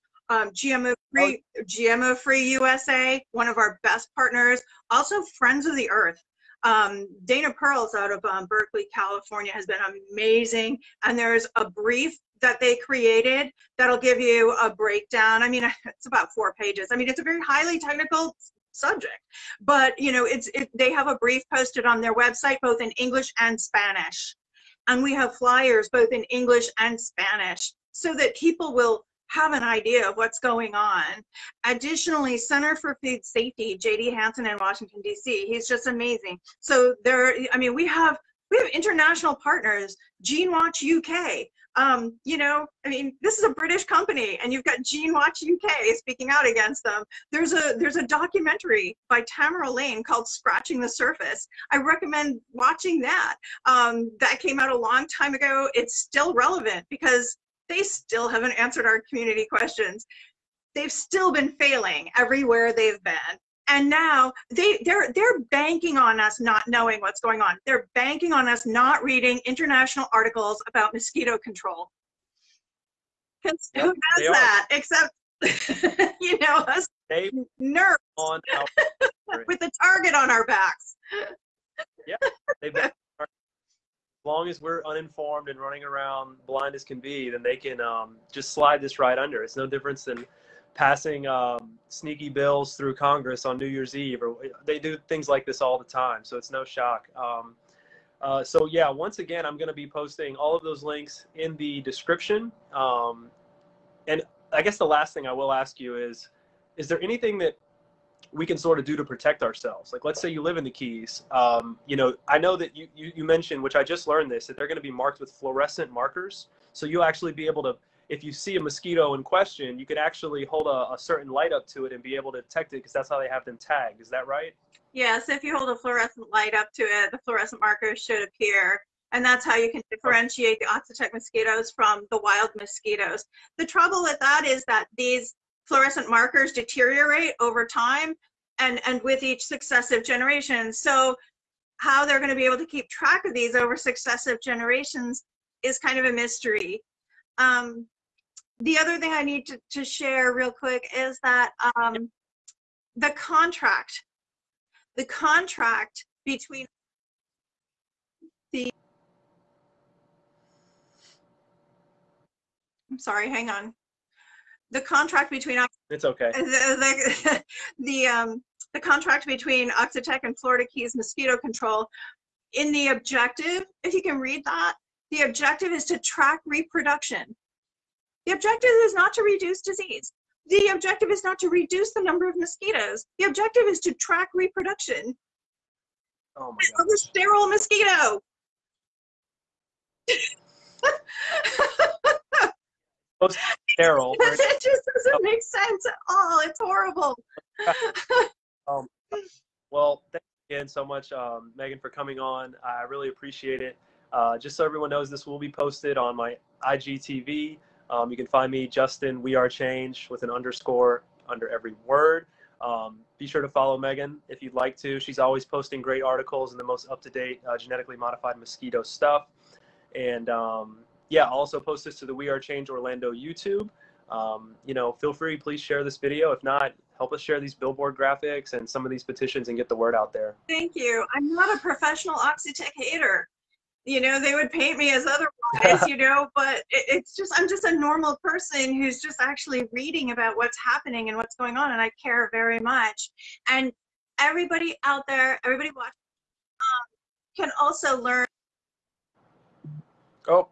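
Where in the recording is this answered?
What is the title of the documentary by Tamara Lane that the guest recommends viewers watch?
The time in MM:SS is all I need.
00:50.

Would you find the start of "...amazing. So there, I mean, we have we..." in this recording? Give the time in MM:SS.
00:35.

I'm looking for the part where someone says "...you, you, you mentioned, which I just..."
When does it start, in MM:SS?
01:52.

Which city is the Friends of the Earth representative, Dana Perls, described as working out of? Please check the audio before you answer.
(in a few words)
Berkeley, California.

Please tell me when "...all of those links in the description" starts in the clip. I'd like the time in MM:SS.
01:40.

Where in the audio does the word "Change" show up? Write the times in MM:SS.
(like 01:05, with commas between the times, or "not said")
03:29, 03:42.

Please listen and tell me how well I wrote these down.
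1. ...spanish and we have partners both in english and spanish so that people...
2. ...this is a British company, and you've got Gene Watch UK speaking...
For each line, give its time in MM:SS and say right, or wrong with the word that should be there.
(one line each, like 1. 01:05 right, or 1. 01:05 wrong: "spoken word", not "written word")
1. 00:23 wrong: "flyers", not "partners"
2. 00:43 right.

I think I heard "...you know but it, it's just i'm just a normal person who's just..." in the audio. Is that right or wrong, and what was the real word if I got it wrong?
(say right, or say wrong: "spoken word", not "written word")
right.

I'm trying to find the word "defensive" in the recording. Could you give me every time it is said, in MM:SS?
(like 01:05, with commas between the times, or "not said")
not said.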